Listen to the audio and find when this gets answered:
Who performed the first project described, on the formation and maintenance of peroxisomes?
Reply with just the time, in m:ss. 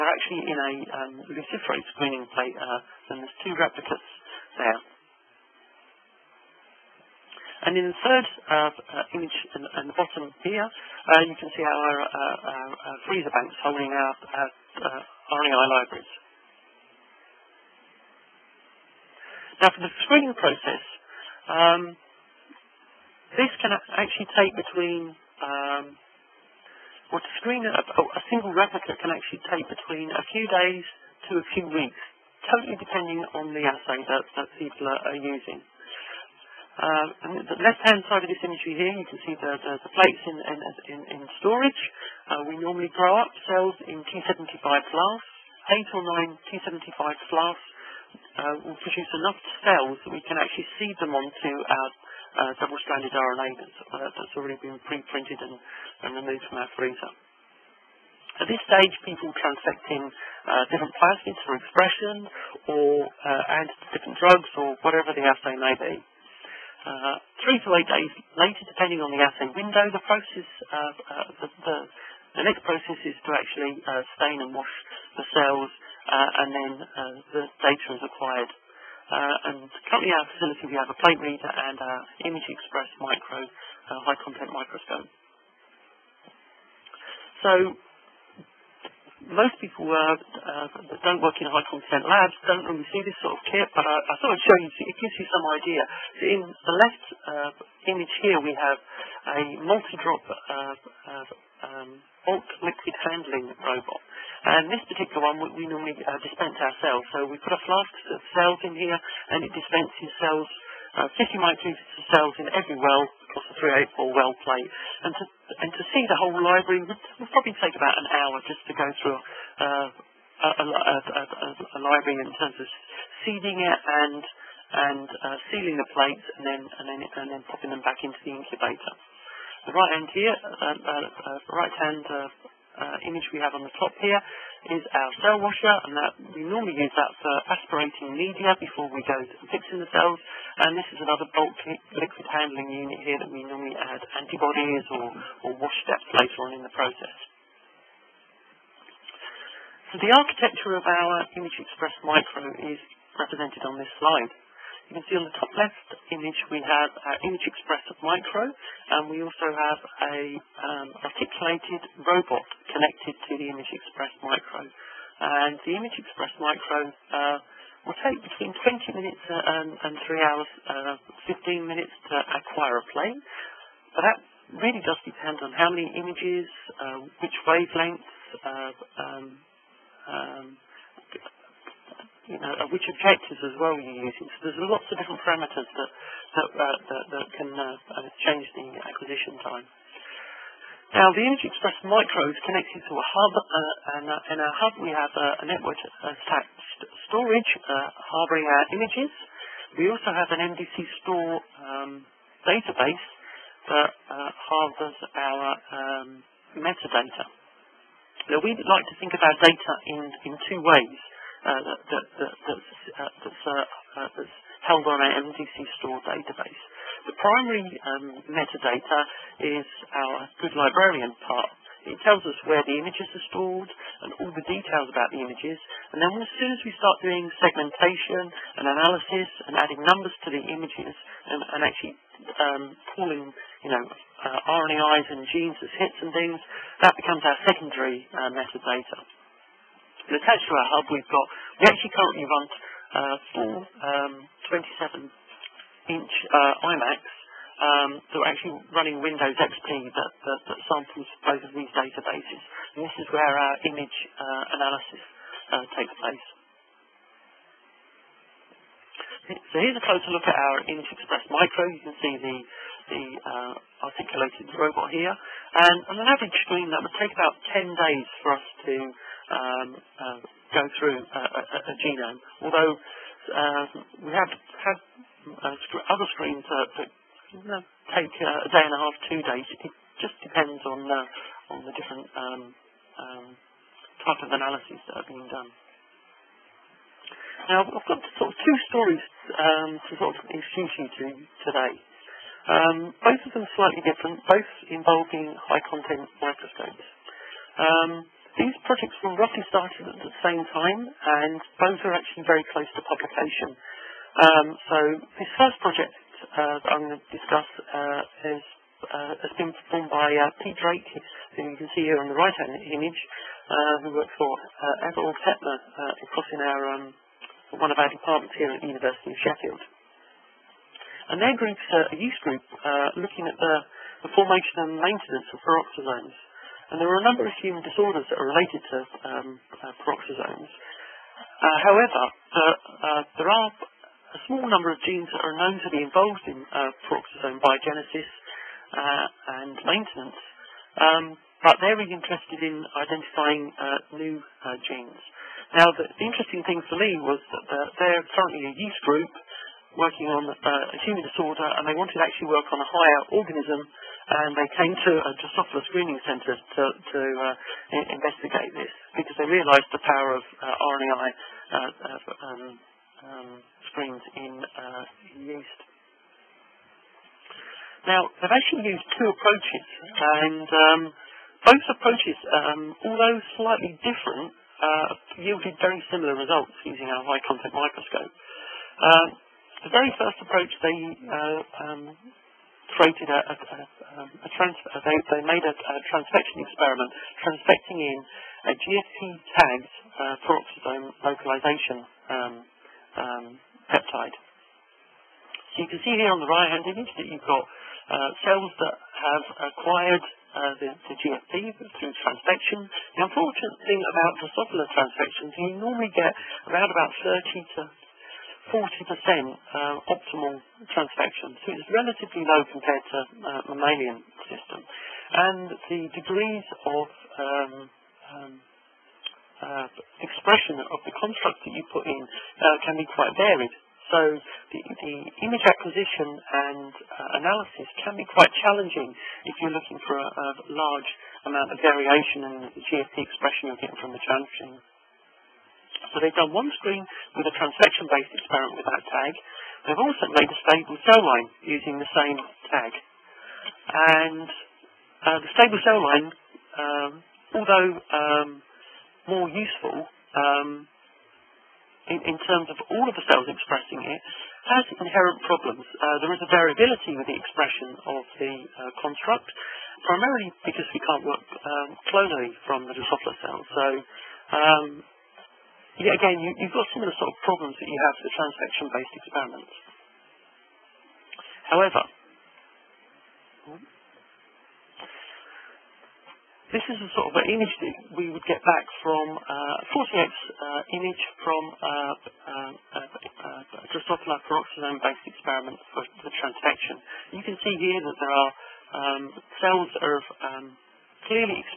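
5:10.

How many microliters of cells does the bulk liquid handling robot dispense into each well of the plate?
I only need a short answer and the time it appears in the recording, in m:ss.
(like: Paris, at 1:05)
50 microliters, at 1:51.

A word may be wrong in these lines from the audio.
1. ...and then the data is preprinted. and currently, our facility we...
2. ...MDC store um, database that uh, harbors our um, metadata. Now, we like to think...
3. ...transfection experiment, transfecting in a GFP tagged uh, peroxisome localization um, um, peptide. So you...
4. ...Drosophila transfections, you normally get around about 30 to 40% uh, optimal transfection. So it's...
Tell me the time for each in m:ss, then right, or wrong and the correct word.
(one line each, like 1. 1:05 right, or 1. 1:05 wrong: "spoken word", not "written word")
1. 1:16 wrong: "acquired", not "preprinted"
2. 3:20 right
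3. 6:25 right
4. 6:44 right.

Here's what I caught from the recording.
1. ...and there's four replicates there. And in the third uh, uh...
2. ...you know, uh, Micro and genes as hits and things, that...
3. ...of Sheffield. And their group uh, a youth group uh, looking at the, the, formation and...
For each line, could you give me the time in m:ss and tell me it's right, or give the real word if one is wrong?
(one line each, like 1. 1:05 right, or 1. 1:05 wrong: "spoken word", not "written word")
1. 0:03 wrong: "two", not "four"
2. 3:53 wrong: "RNAs", not "Micro"
3. 5:19 right.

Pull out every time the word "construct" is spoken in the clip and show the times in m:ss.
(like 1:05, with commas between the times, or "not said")
7:00, 7:38.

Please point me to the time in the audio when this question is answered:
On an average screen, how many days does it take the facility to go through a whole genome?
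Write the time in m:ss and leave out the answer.
4:27.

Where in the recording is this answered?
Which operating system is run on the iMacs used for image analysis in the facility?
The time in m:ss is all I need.
4:08.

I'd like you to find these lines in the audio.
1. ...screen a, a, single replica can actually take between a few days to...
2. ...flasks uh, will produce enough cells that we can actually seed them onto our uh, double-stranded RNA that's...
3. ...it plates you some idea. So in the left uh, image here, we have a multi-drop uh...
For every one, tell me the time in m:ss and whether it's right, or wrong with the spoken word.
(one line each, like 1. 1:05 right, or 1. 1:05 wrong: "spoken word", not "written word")
1. 0:27 right
2. 0:47 right
3. 1:34 wrong: "gives", not "plates".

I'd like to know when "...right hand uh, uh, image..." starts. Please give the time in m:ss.
2:11.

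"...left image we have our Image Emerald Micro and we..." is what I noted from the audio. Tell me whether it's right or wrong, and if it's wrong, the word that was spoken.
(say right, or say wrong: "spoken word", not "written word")
wrong: "Express", not "Emerald".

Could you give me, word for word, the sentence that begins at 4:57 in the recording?
Um, these projects were roughly started at the same time, and both are actually very close to publication.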